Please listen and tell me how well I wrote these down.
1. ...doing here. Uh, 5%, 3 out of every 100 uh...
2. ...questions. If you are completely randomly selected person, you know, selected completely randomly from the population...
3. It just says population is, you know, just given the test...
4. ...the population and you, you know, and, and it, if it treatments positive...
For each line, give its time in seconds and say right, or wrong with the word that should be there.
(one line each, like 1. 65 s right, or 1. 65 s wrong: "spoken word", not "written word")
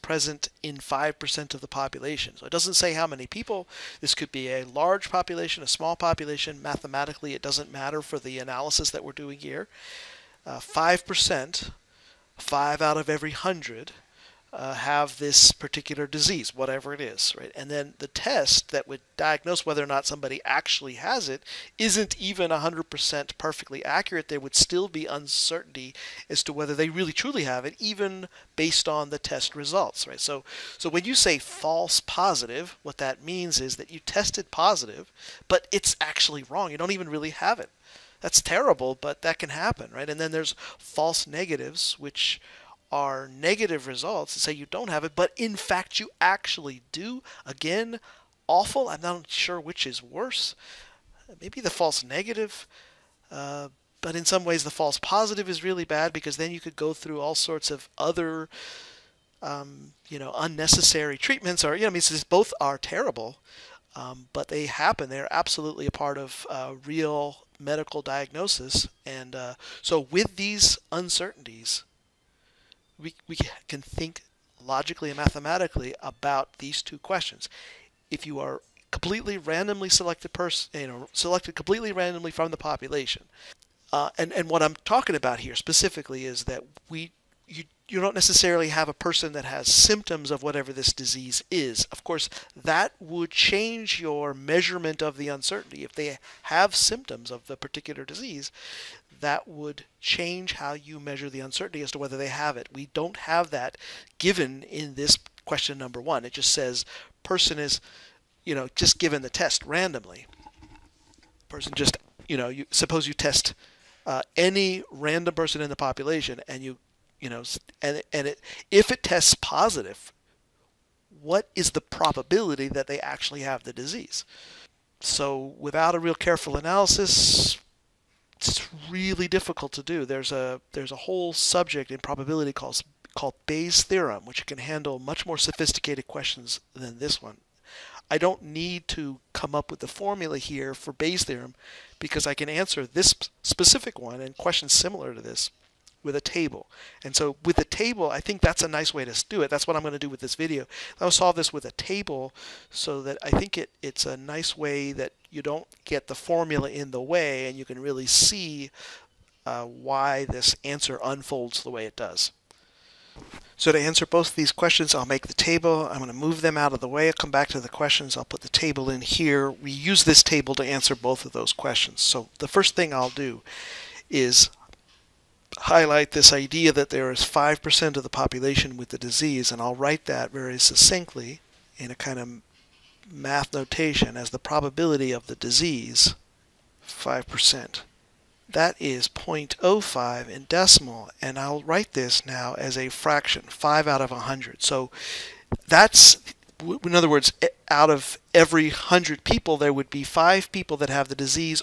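1. 9 s wrong: "5", not "3"
2. 76 s right
3. 106 s wrong: "person", not "population"
4. 115 s wrong: "tests", not "treatments".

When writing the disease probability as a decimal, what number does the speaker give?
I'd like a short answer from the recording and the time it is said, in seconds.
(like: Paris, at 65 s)
0.05, at 189 s.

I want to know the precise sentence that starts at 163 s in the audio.
So to answer both of these questions, I'll make the table.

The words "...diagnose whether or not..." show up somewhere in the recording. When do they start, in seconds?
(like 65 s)
19 s.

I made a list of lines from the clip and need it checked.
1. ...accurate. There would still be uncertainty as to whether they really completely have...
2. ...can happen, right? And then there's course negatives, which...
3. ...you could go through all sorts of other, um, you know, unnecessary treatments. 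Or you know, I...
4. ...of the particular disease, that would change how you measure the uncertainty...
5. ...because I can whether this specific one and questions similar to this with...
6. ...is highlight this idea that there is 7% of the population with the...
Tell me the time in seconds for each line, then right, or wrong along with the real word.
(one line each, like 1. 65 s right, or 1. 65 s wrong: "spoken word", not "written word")
1. 23 s wrong: "truly", not "completely"
2. 39 s wrong: "false", not "course"
3. 56 s right
4. 97 s right
5. 141 s wrong: "answer", not "whether"
6. 174 s wrong: "5", not "7".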